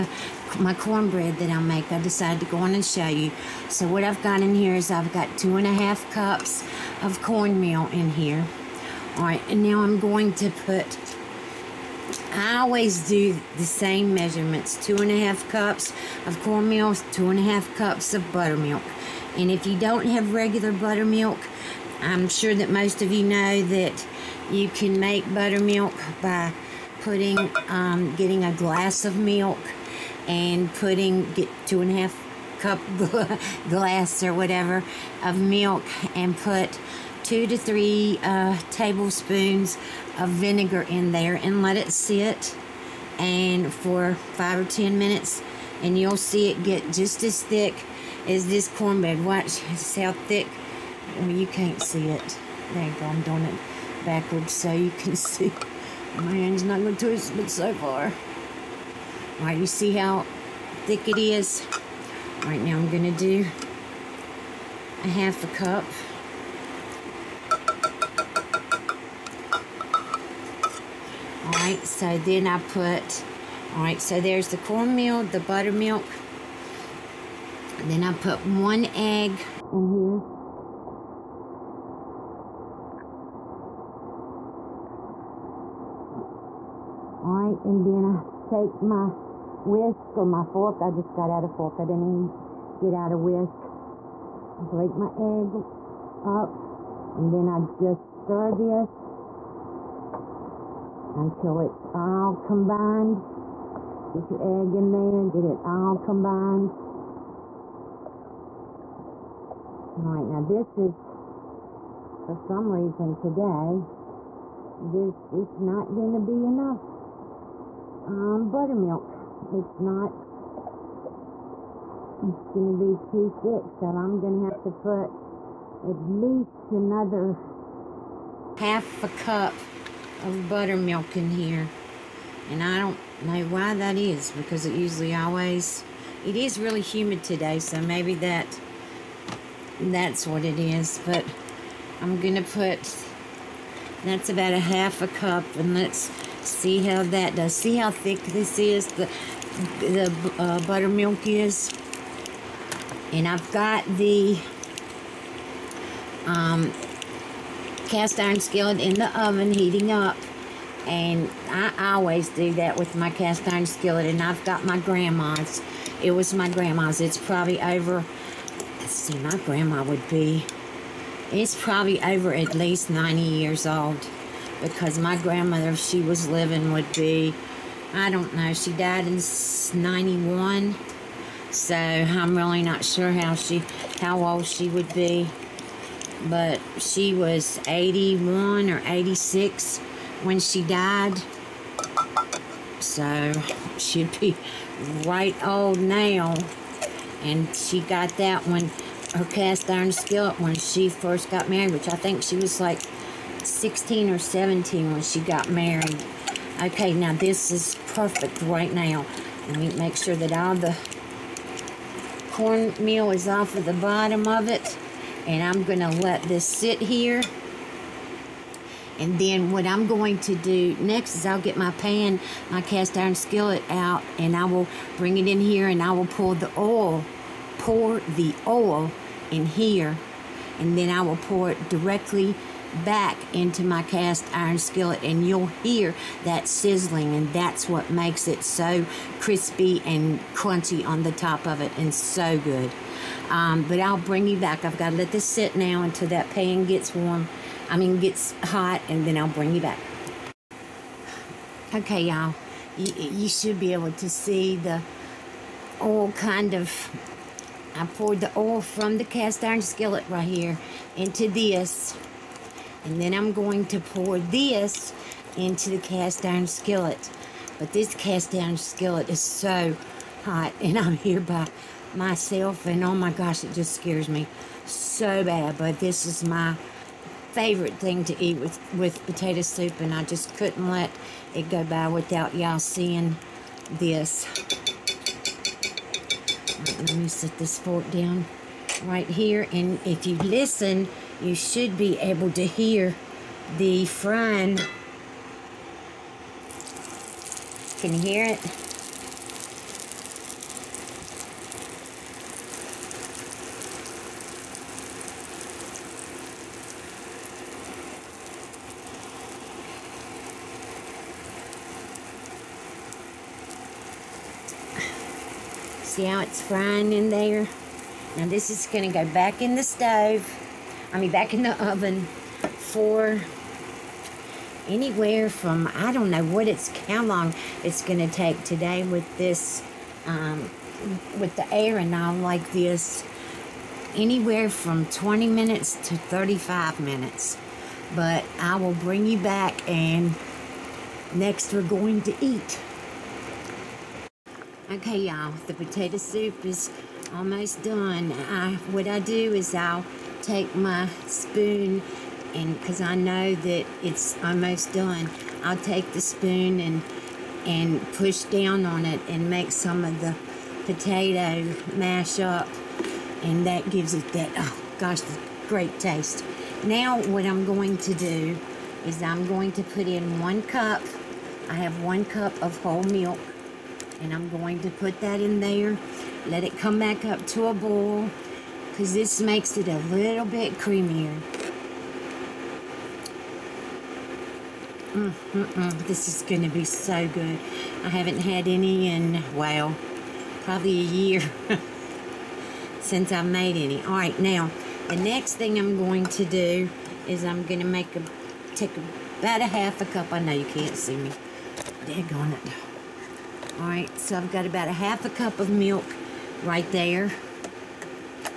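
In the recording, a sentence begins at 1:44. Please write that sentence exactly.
Get your egg in there, get it all combined.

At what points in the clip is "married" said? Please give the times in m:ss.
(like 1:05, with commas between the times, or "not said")
3:21, 3:25.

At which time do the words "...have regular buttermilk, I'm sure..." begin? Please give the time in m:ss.
0:20.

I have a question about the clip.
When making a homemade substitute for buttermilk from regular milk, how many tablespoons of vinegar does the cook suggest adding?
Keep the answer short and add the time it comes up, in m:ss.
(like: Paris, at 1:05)
2 to 3, at 0:37.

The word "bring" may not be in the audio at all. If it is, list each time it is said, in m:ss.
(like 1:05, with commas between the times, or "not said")
3:44, 4:03, 4:09, 5:38.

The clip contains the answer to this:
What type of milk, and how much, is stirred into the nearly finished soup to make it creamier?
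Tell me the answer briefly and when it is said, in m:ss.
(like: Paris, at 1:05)
1 cup whole milk, at 6:11.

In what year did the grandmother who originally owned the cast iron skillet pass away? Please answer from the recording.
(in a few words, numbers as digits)
1991.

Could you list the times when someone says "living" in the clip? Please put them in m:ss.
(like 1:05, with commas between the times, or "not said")
2:56.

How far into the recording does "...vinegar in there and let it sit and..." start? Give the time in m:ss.
0:40.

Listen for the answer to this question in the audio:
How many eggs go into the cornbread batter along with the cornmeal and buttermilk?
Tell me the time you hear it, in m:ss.
1:18.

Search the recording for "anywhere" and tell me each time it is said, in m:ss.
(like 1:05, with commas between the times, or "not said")
5:24, 5:33.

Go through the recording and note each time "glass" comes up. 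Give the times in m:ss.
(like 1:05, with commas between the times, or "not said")
0:28, 0:33.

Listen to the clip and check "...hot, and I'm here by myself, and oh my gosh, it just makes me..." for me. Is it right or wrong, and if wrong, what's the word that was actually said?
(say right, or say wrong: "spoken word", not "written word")
wrong: "scares", not "makes".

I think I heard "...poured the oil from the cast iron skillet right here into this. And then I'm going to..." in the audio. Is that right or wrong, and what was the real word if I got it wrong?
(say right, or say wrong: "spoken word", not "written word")
right.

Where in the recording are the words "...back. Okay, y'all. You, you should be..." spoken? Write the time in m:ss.
4:09.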